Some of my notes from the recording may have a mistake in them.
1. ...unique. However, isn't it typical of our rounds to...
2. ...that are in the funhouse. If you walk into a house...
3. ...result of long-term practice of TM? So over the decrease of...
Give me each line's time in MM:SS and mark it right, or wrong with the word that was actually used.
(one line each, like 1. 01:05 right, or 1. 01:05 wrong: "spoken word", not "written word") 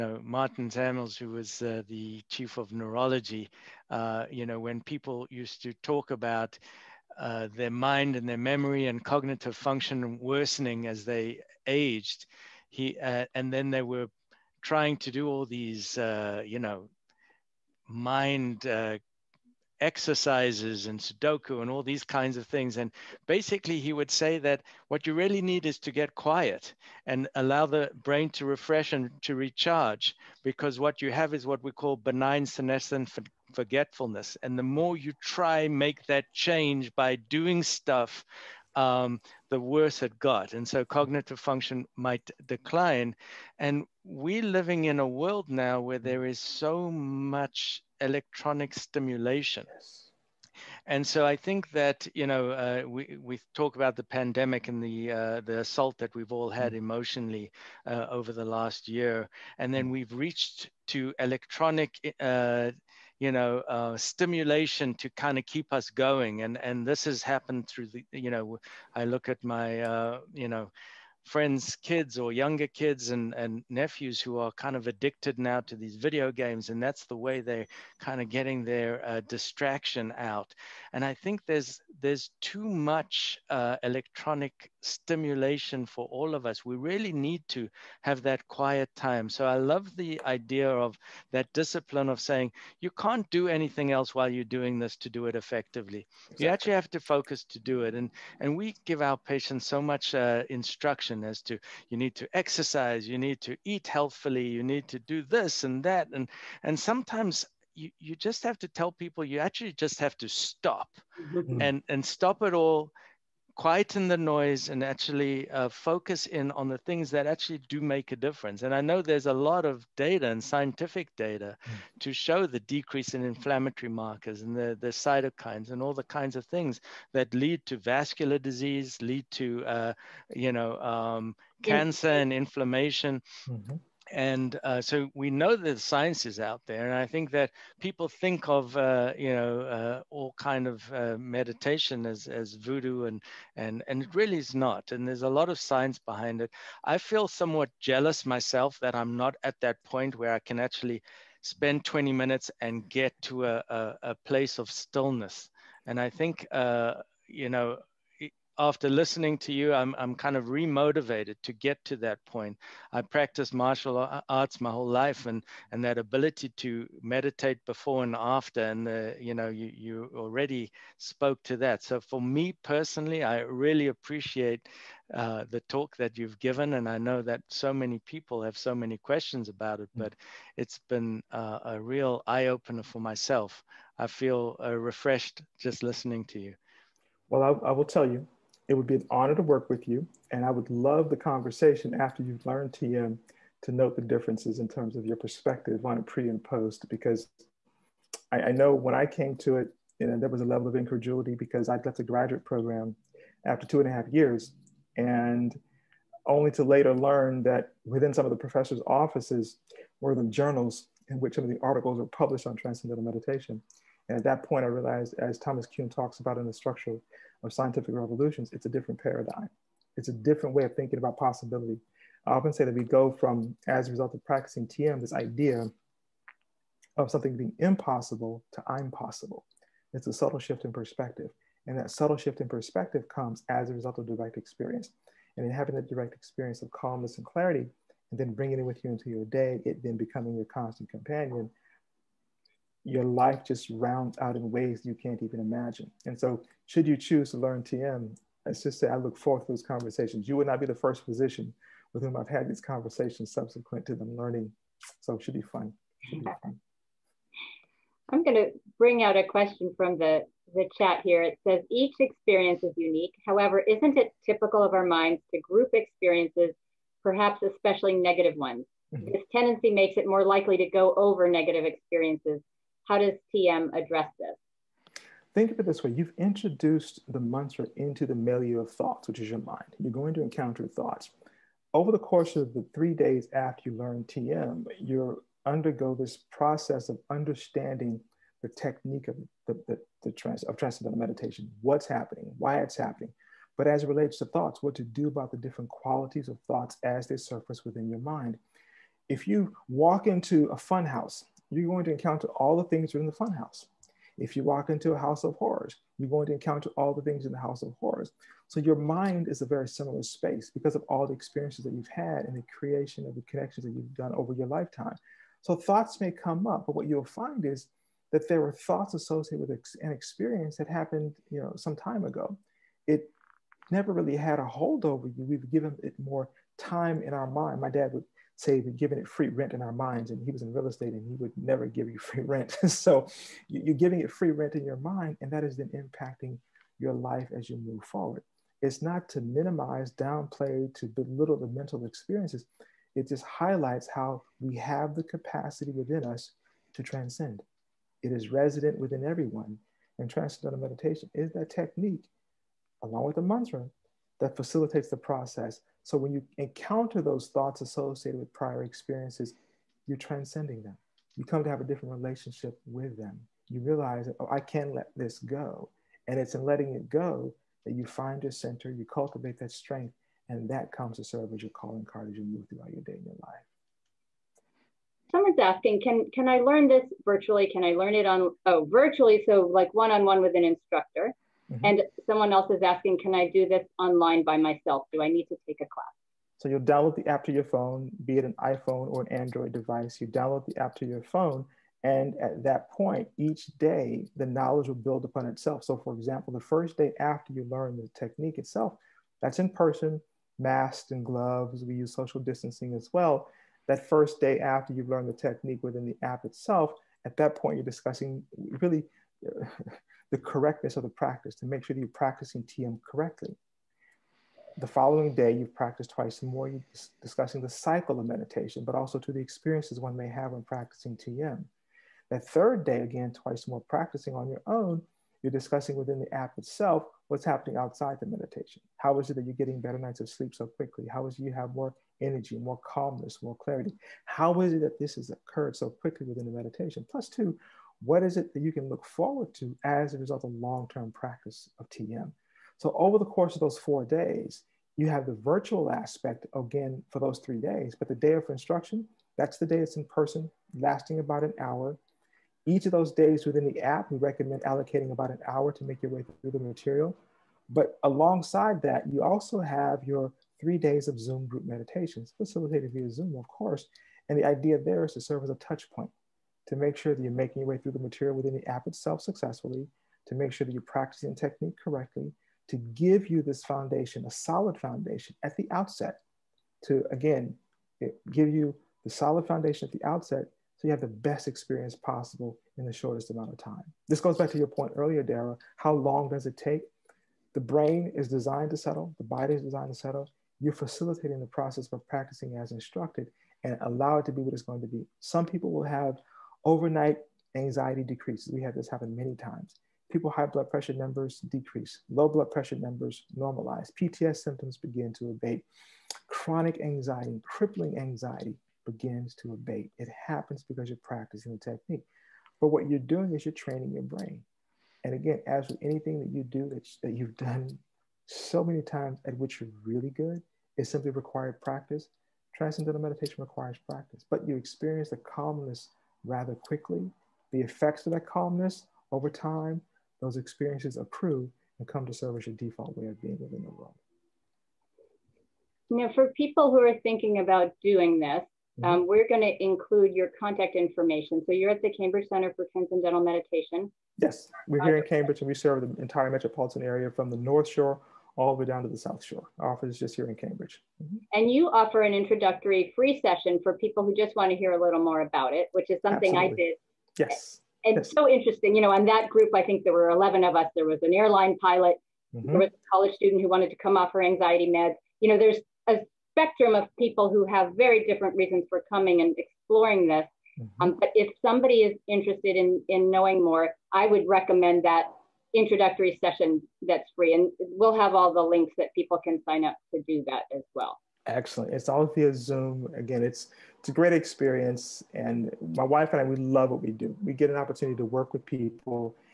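1. 04:22 wrong: "minds", not "rounds"
2. 05:02 right
3. 07:19 wrong: "course", not "decrease".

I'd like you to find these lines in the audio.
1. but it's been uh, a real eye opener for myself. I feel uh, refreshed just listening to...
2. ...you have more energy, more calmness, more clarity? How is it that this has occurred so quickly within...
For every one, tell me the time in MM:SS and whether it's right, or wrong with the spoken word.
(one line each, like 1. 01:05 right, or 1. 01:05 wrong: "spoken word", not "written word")
1. 03:00 right
2. 07:11 right.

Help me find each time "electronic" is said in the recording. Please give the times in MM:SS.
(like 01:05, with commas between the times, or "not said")
00:47, 01:01, 01:23.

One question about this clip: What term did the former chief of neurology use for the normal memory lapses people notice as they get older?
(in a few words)
benign senescent forgetfulness.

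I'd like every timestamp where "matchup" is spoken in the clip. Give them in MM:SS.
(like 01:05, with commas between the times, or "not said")
not said.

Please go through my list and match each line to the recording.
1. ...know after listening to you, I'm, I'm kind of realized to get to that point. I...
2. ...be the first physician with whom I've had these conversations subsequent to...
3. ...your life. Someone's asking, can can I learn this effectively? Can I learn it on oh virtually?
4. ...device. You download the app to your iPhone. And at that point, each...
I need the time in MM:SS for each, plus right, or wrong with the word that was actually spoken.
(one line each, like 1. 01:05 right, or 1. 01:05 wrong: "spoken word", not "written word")
1. 02:37 wrong: "remotivated", not "realized"
2. 04:10 right
3. 06:13 wrong: "virtually", not "effectively"
4. 06:29 wrong: "phone", not "iPhone".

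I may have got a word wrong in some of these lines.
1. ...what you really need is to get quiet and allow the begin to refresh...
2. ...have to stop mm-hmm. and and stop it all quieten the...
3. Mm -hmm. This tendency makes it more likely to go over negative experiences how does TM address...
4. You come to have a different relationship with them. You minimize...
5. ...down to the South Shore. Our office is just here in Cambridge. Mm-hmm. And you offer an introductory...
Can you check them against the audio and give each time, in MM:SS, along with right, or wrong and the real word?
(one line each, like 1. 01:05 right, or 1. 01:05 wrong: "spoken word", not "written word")
1. 00:24 wrong: "brain", not "begin"
2. 01:49 right
3. 04:28 right
4. 06:01 wrong: "realize", not "minimize"
5. 09:08 right.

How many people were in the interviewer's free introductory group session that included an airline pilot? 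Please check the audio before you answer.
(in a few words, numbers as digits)
11.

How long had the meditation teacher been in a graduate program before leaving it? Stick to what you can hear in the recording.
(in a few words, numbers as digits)
two and a half years.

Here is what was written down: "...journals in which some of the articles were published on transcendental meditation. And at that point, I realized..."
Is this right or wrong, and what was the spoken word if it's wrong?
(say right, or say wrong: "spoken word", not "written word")
right.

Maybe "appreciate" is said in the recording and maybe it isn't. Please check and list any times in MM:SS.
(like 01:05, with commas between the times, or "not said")
02:53.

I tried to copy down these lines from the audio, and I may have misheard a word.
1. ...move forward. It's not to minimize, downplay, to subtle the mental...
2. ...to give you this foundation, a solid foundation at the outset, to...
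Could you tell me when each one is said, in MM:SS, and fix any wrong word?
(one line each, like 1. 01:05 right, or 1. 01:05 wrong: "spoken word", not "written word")
1. 05:37 wrong: "belittle", not "subtle"
2. 07:52 right.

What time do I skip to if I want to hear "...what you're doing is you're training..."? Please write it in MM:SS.
08:32.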